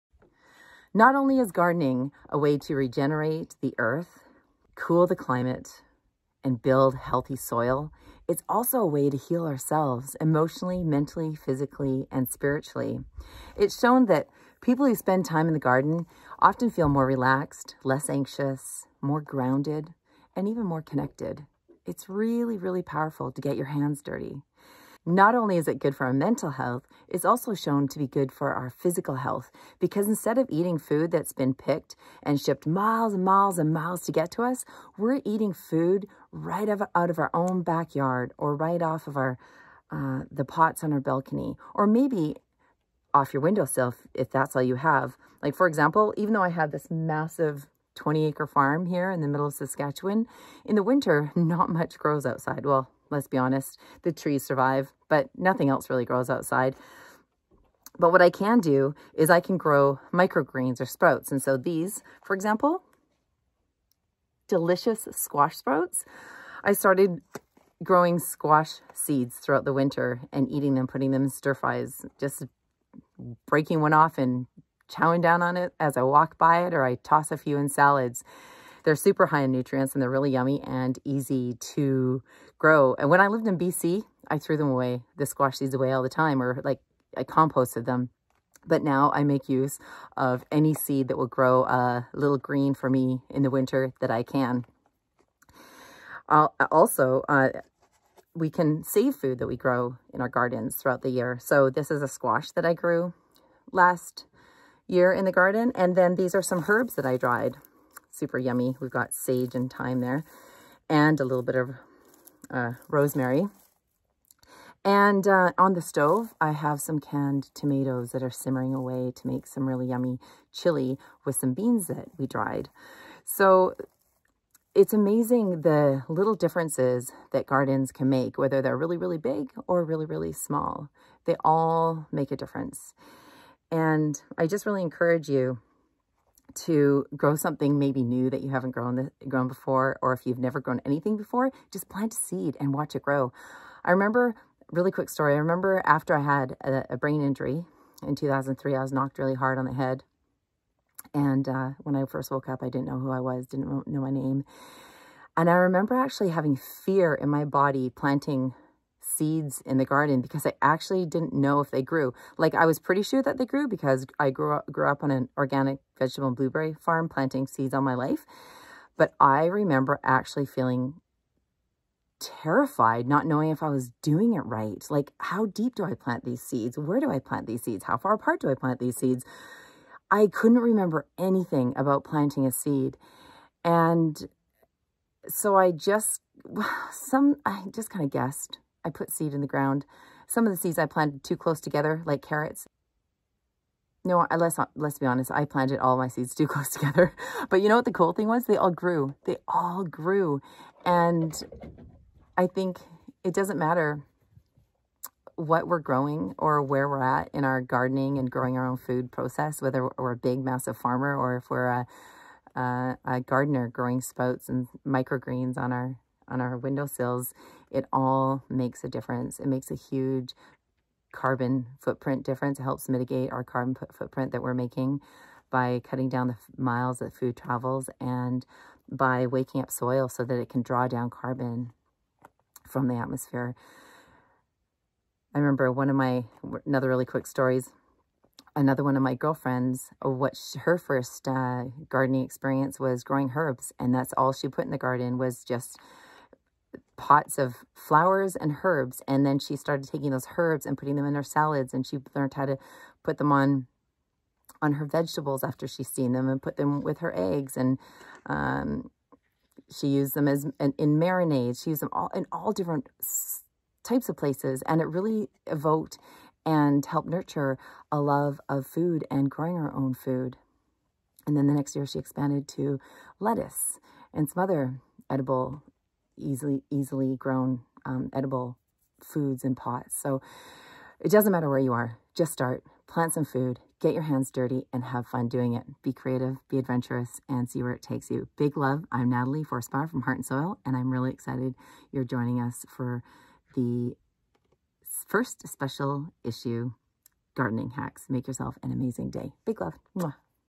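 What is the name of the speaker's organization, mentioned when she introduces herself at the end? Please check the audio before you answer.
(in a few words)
Heart and Soil.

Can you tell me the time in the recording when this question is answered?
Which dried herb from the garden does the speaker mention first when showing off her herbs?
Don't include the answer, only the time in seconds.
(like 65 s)
109 s.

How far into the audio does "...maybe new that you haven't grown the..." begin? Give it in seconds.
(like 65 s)
137 s.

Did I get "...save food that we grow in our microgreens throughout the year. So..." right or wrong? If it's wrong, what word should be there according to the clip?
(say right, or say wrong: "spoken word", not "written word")
wrong: "gardens", not "microgreens".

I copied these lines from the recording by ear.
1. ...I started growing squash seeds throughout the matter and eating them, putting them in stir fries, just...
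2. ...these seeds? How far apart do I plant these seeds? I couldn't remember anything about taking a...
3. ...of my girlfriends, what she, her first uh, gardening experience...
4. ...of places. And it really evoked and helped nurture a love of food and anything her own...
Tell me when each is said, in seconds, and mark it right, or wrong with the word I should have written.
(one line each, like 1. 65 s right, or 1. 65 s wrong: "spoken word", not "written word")
1. 66 s wrong: "winter", not "matter"
2. 177 s wrong: "planting", not "taking"
3. 238 s right
4. 264 s wrong: "growing", not "anything".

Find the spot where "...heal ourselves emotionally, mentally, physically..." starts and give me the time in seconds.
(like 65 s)
9 s.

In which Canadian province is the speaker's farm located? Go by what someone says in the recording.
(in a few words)
Saskatchewan.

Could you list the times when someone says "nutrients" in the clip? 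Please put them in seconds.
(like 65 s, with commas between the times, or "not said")
79 s.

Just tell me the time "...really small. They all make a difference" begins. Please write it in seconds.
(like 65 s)
130 s.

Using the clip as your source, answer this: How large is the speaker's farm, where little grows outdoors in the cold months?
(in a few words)
20 acres.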